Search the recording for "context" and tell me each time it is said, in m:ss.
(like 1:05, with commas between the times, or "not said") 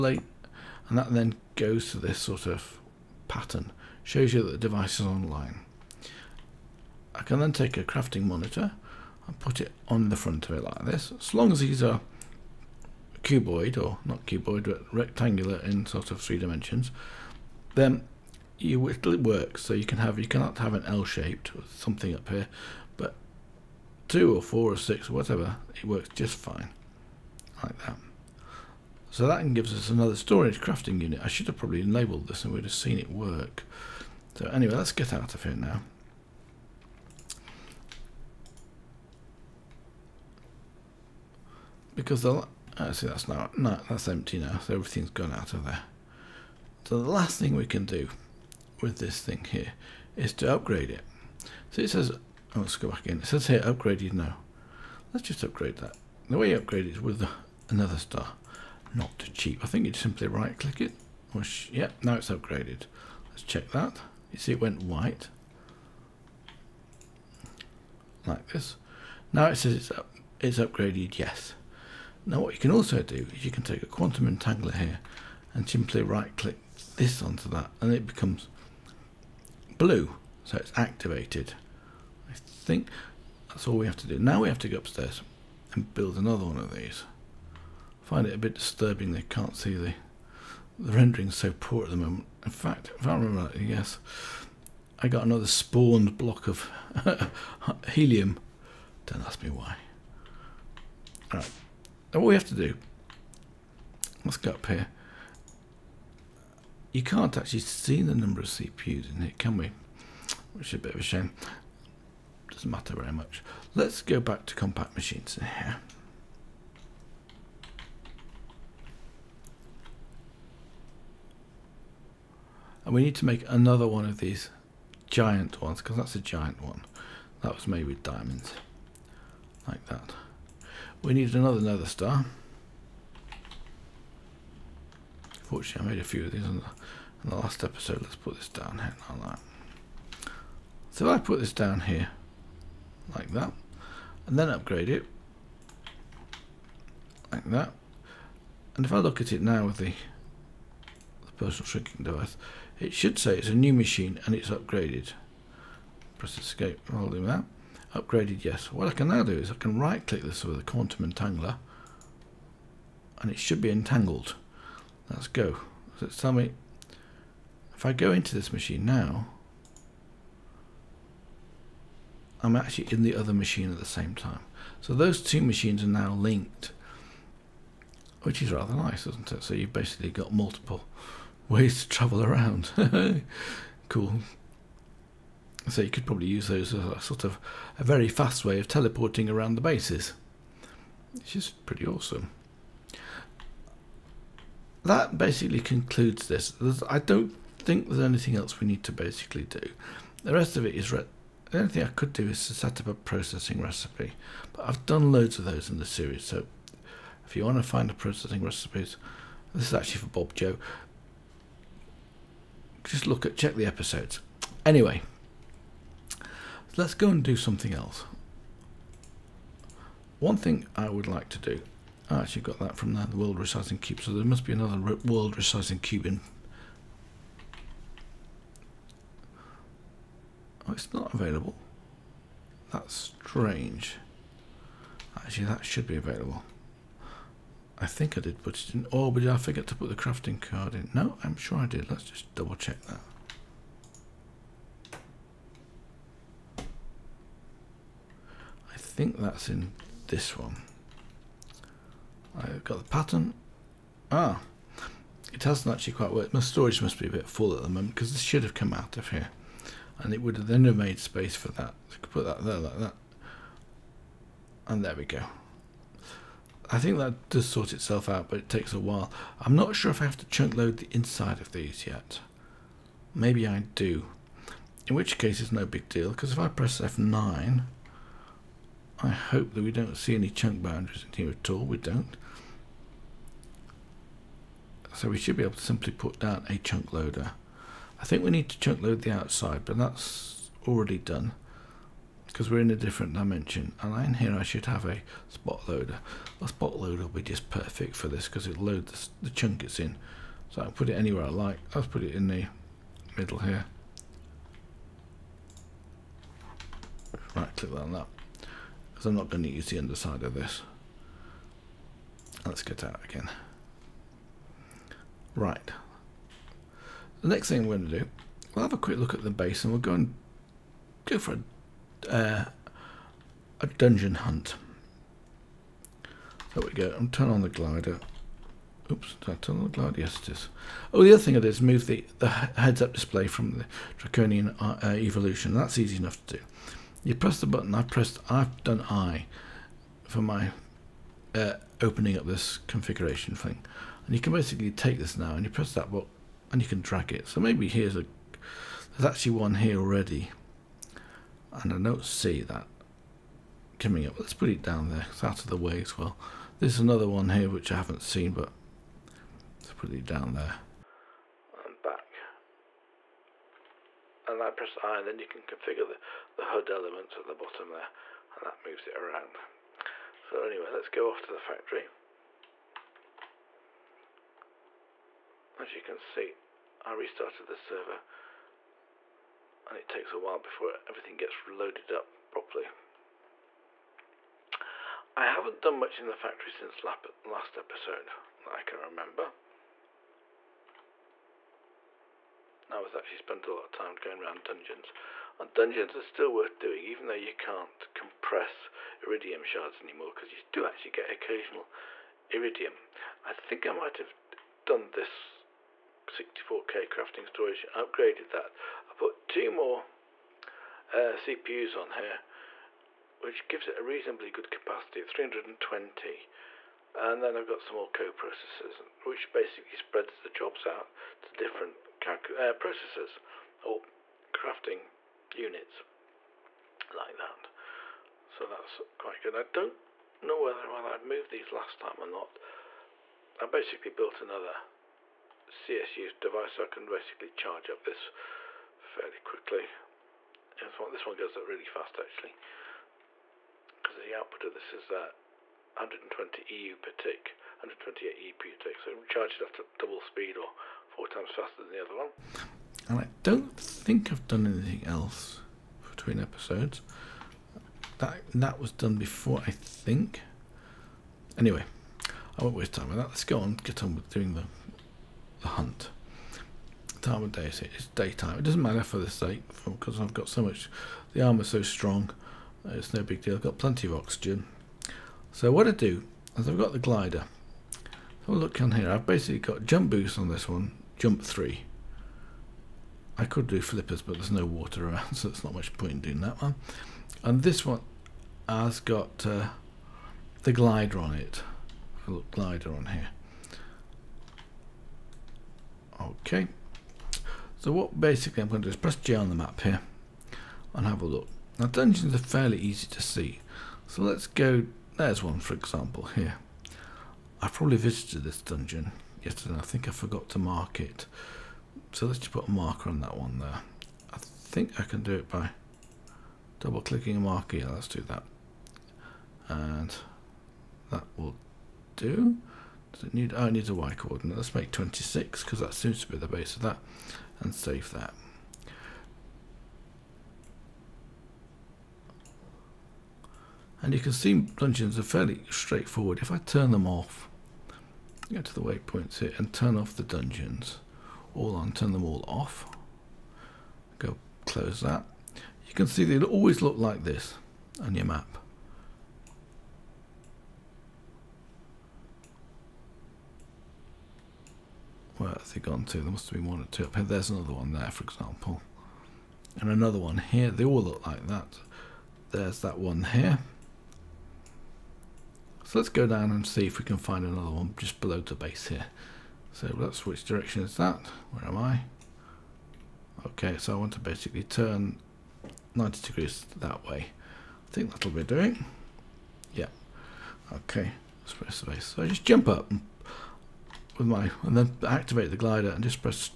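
not said.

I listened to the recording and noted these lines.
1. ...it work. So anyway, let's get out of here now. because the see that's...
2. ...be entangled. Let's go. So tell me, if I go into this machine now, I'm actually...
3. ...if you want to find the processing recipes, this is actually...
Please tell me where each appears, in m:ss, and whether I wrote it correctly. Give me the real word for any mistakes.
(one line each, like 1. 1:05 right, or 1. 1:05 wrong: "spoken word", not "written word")
1. 0:32 right
2. 2:43 right
3. 3:27 right.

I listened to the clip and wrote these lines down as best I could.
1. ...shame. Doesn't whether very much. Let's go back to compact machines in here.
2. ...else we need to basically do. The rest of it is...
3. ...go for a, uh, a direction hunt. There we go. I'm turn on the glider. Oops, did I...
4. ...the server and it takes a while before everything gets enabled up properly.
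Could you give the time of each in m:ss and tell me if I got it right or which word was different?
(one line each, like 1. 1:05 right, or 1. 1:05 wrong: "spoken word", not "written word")
1. 1:51 wrong: "matter", not "whether"
2. 3:18 right
3. 5:21 wrong: "dungeon", not "direction"
4. 6:17 wrong: "loaded", not "enabled".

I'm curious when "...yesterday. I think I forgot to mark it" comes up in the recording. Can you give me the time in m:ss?
8:29.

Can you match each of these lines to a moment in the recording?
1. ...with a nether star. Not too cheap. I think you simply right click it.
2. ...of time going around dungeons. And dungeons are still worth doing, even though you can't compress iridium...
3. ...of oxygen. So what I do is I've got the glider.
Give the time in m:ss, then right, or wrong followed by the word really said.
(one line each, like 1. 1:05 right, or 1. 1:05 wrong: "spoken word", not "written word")
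1. 0:56 right
2. 6:33 right
3. 7:53 right.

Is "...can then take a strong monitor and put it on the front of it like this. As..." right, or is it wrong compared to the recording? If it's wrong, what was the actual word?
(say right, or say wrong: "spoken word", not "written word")
wrong: "crafting", not "strong".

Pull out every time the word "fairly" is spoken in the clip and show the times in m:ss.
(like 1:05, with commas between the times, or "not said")
7:18, 8:22, 8:55.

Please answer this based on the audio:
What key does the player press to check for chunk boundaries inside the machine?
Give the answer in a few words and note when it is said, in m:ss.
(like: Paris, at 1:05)
F9, at 4:36.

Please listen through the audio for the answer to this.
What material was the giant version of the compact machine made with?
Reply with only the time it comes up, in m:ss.
2:08.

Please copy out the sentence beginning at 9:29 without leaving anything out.
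So that's which direction is that?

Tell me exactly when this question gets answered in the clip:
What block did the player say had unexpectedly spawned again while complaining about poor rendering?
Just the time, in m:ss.
1:37.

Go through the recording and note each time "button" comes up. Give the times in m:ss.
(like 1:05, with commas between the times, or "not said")
5:37, 5:45.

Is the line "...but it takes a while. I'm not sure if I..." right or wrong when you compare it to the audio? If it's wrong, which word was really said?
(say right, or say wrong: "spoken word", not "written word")
right.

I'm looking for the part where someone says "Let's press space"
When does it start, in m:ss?
9:41.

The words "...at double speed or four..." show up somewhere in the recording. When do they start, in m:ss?
7:29.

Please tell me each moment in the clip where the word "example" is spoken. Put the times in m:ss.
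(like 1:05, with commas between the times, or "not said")
8:25, 9:18.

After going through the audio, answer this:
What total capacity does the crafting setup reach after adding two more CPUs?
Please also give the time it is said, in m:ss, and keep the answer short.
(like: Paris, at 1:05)
320, at 6:55.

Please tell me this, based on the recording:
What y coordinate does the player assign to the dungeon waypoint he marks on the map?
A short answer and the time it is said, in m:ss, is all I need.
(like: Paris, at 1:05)
26, at 8:44.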